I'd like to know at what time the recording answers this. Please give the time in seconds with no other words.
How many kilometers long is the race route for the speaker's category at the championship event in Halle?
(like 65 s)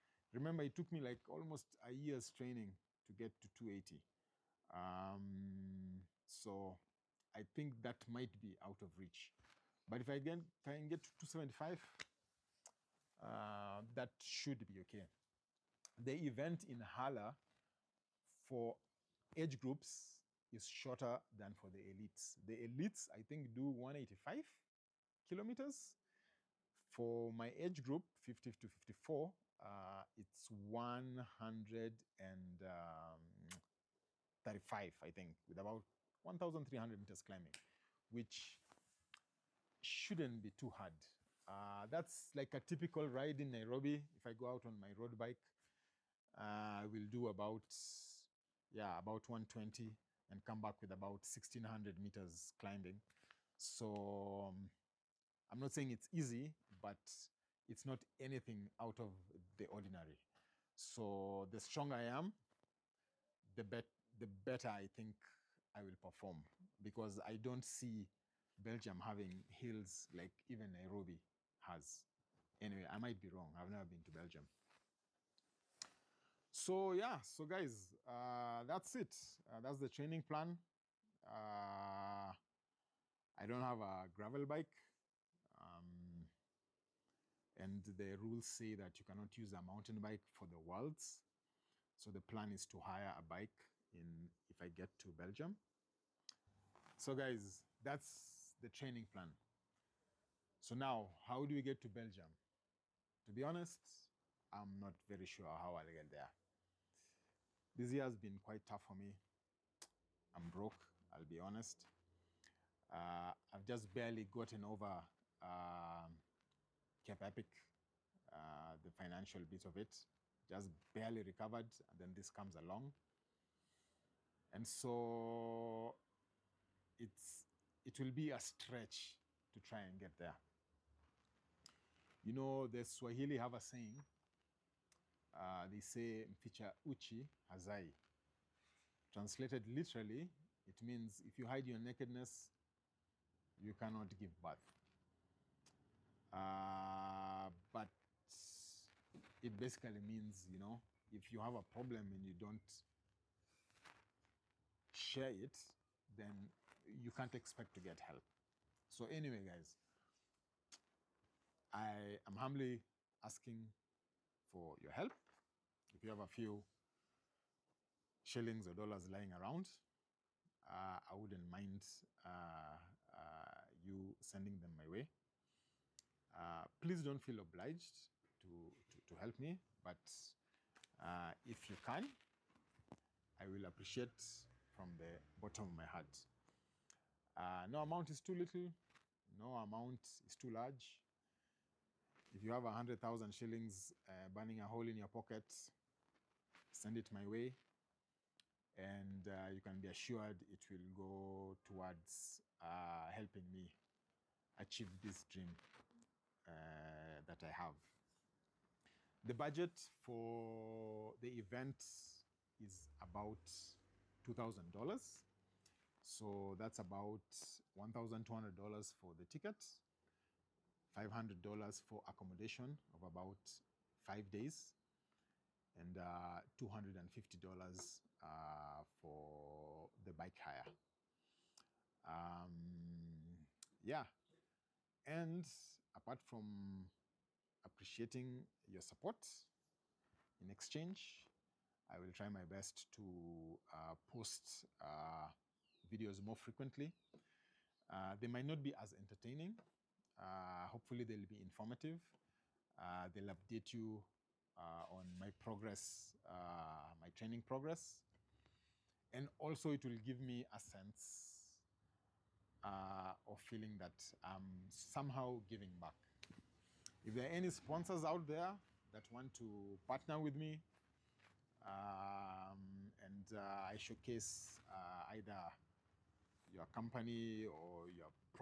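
30 s.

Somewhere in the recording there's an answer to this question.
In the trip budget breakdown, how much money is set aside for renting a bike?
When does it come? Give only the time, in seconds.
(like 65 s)
226 s.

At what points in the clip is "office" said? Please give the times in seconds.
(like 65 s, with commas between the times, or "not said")
not said.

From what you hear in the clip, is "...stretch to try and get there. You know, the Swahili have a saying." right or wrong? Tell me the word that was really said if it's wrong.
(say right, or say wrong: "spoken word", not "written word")
right.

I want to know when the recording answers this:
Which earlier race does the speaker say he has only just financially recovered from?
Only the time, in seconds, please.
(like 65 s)
117 s.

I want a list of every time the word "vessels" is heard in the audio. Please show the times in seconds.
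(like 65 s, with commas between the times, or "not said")
not said.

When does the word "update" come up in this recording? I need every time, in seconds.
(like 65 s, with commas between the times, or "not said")
253 s.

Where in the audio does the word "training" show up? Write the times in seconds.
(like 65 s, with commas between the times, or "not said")
2 s, 79 s, 98 s, 257 s.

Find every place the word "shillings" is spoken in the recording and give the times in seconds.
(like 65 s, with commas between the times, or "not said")
168 s, 193 s.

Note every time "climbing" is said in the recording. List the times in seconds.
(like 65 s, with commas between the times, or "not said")
37 s, 52 s.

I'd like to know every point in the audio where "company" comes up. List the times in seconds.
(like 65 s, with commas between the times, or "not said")
276 s.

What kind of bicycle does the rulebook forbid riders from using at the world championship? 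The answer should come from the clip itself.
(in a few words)
mountain bike.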